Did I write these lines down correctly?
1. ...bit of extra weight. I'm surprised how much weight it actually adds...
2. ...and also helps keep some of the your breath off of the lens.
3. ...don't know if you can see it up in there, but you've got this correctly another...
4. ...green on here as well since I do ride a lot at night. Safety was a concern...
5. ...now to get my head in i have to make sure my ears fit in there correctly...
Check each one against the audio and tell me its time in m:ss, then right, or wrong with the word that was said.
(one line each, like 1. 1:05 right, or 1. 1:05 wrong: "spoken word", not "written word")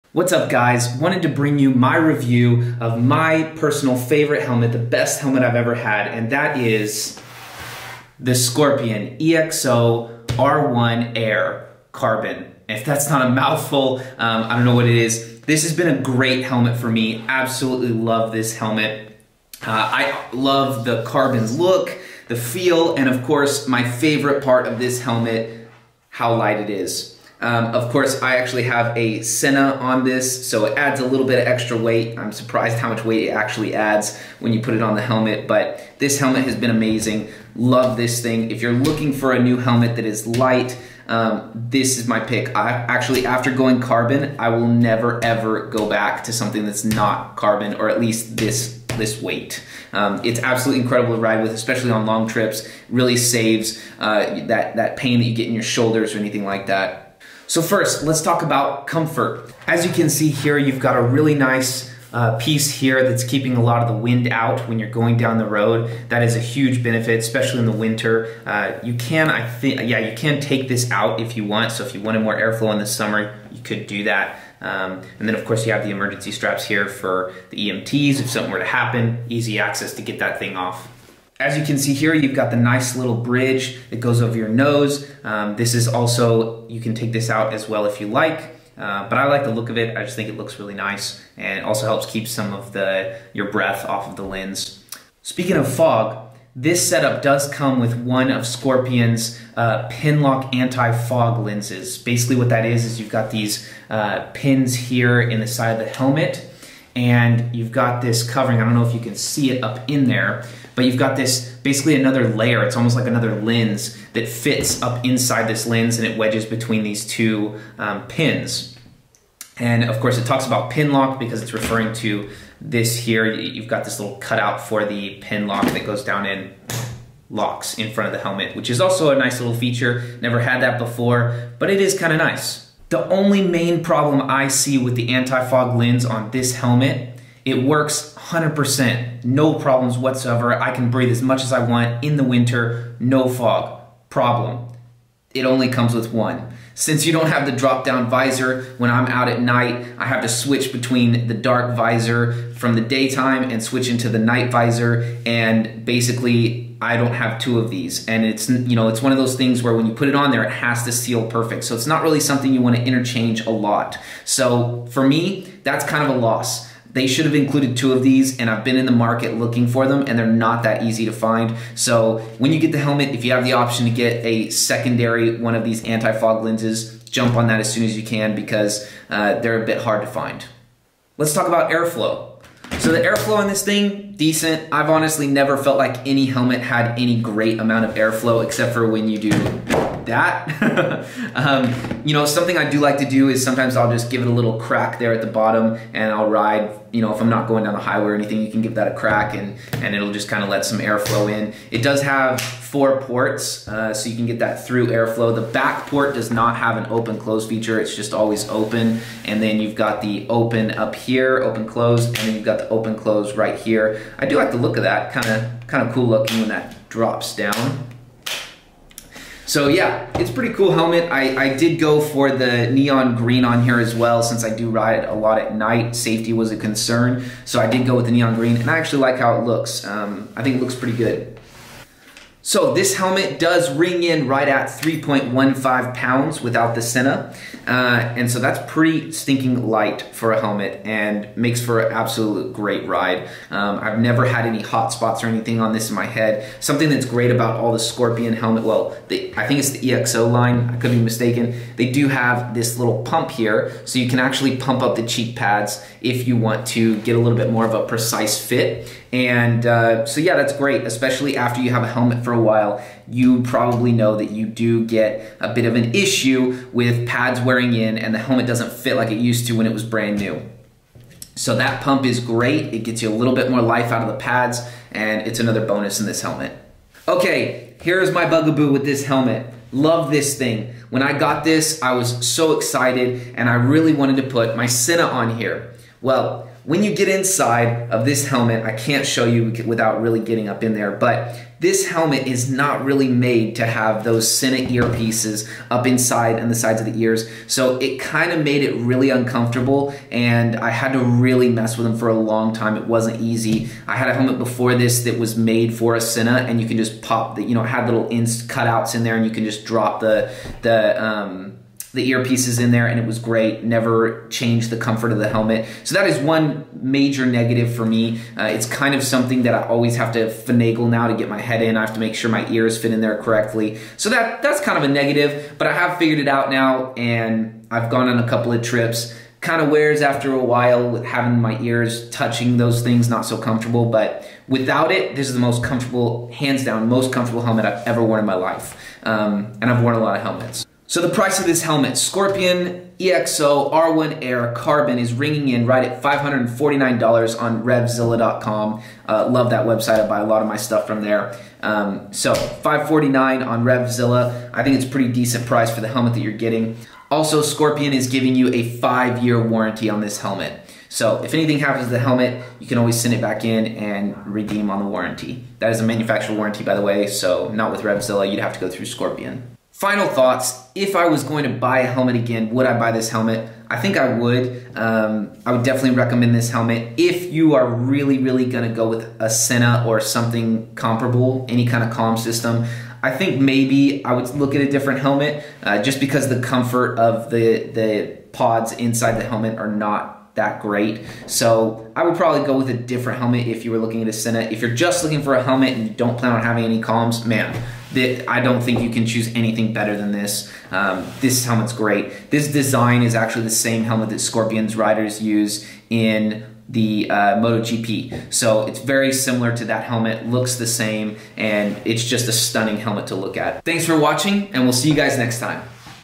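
1. 0:31 right
2. 1:31 right
3. 1:48 wrong: "basically", not "correctly"
4. 3:43 right
5. 5:20 right.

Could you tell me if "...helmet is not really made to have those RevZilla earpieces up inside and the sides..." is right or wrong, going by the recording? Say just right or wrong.
wrong.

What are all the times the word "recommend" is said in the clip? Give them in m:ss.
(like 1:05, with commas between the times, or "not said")
6:15.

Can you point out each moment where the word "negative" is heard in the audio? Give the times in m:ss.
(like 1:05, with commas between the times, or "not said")
5:17, 5:24.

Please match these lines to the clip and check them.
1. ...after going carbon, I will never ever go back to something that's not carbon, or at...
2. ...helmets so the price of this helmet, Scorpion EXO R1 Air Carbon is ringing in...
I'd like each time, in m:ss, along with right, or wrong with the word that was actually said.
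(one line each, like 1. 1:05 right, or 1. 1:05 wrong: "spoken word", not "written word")
1. 0:43 right
2. 5:40 right.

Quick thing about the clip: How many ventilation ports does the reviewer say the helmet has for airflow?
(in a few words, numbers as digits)
4.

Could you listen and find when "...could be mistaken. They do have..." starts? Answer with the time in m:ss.
4:10.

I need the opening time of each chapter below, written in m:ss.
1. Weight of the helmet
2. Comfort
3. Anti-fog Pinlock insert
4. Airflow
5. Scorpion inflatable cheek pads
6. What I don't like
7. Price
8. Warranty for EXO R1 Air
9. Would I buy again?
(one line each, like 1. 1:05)
1. 0:25
2. 0:57
3. 1:35
4. 3:01
5. 4:06
6. 4:36
7. 5:40
8. 5:57
9. 6:10.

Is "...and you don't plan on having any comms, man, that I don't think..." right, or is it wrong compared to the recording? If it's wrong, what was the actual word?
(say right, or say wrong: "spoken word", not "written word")
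right.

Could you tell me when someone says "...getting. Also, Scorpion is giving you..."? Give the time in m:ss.
5:56.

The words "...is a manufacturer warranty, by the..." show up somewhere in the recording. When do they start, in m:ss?
6:05.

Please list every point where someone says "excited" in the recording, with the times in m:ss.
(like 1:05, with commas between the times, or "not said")
4:42.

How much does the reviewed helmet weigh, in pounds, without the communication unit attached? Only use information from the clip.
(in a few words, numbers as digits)
3.15 pounds.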